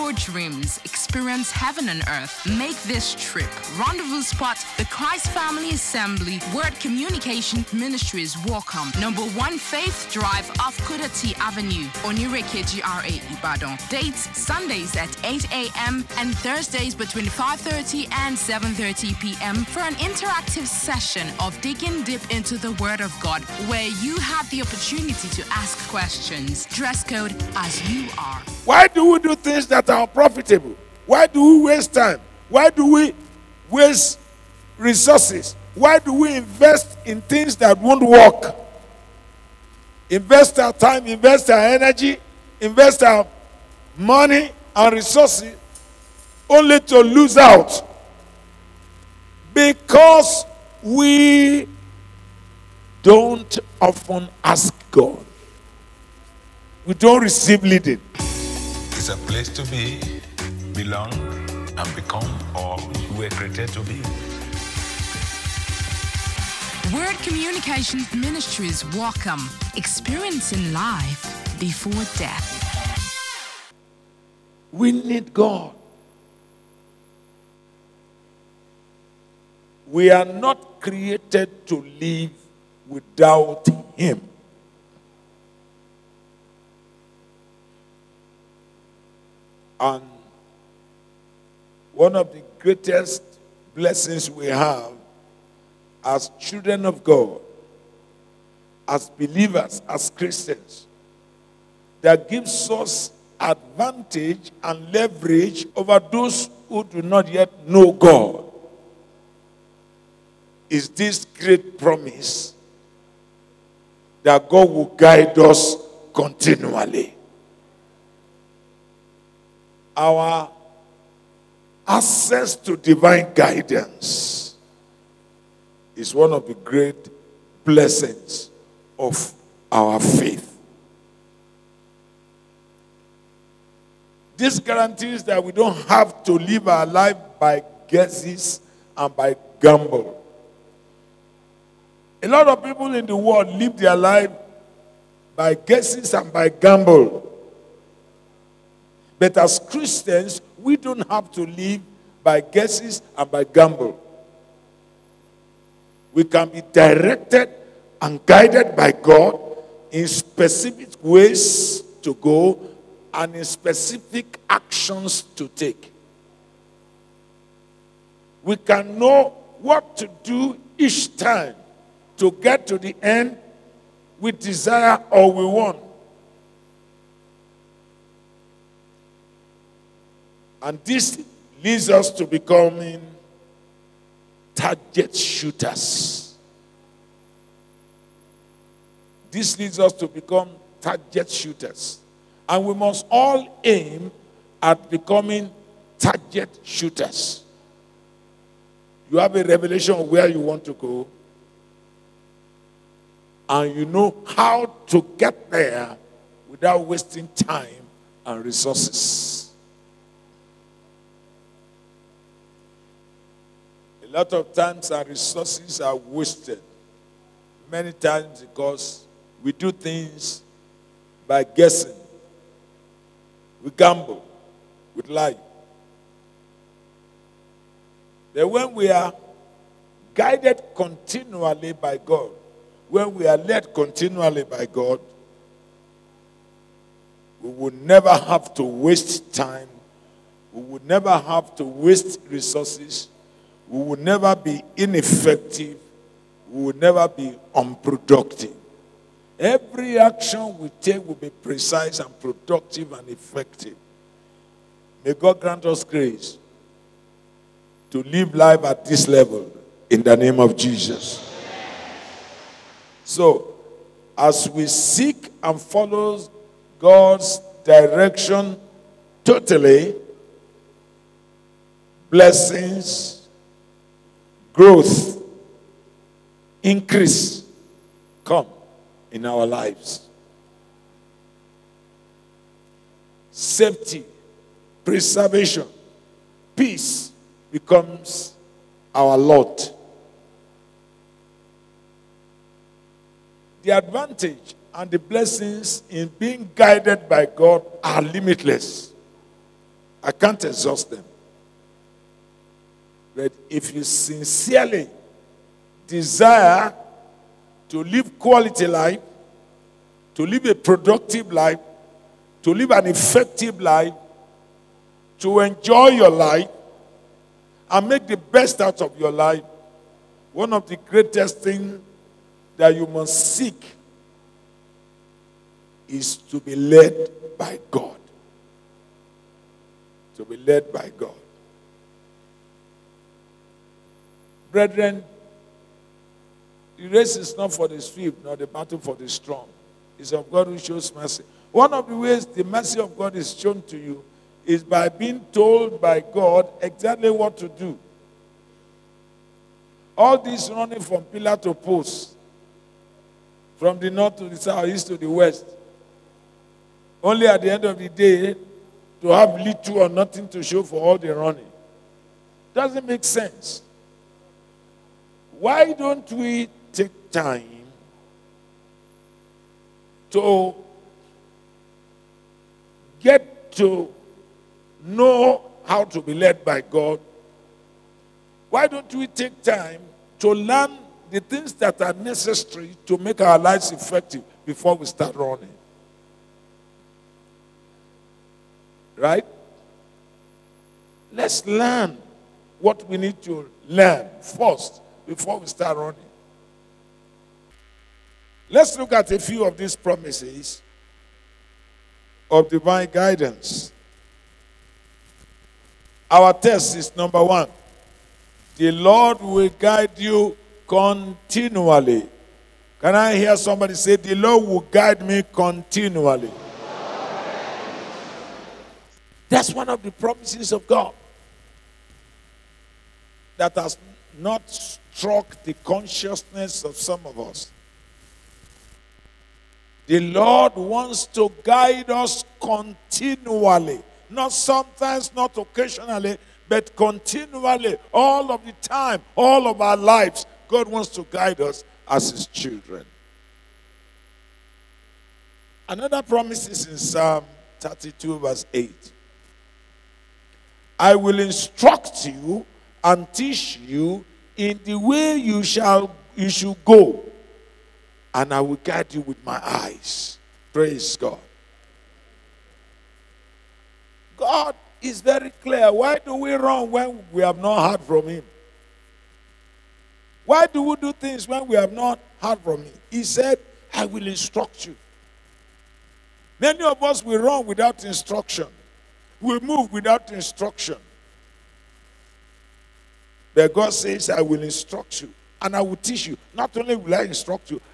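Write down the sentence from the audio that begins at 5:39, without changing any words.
It's of God who shows mercy.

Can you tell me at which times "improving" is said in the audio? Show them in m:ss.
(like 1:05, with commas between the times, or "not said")
not said.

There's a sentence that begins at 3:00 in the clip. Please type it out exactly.
And this leads us to becoming target shooters.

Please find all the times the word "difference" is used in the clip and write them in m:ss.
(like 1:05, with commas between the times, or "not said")
not said.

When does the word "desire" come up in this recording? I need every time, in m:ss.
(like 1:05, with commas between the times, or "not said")
2:54, 5:05.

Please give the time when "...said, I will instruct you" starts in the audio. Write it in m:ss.
7:53.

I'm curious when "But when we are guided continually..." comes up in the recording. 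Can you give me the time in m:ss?
3:48.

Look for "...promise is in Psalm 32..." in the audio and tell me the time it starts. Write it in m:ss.
7:26.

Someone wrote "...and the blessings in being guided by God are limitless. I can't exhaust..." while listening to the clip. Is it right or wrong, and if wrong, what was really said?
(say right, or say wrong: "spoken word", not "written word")
right.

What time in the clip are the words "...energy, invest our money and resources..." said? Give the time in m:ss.
0:41.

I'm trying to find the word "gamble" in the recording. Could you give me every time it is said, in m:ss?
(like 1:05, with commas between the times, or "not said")
2:19, 2:26, 2:33, 3:43.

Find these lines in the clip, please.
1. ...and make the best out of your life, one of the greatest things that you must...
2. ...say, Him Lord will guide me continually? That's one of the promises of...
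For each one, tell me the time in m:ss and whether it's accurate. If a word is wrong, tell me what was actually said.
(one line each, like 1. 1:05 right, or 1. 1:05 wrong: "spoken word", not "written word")
1. 5:17 right
2. 6:53 wrong: "The", not "Him".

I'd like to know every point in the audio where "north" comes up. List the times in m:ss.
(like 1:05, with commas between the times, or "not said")
5:53.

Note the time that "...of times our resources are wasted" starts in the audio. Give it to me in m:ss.
3:34.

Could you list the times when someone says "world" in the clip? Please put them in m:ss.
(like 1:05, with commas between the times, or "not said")
2:23.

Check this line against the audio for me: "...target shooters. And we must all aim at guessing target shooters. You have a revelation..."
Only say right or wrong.
wrong.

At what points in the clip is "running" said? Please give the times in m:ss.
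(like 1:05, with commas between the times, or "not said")
5:50, 6:01, 6:25, 6:35.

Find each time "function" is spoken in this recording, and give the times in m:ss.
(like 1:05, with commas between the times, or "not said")
not said.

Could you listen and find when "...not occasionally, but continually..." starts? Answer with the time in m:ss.
7:15.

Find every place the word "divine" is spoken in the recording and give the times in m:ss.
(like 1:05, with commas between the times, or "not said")
2:02, 6:42.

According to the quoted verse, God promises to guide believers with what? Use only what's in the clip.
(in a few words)
my eyes.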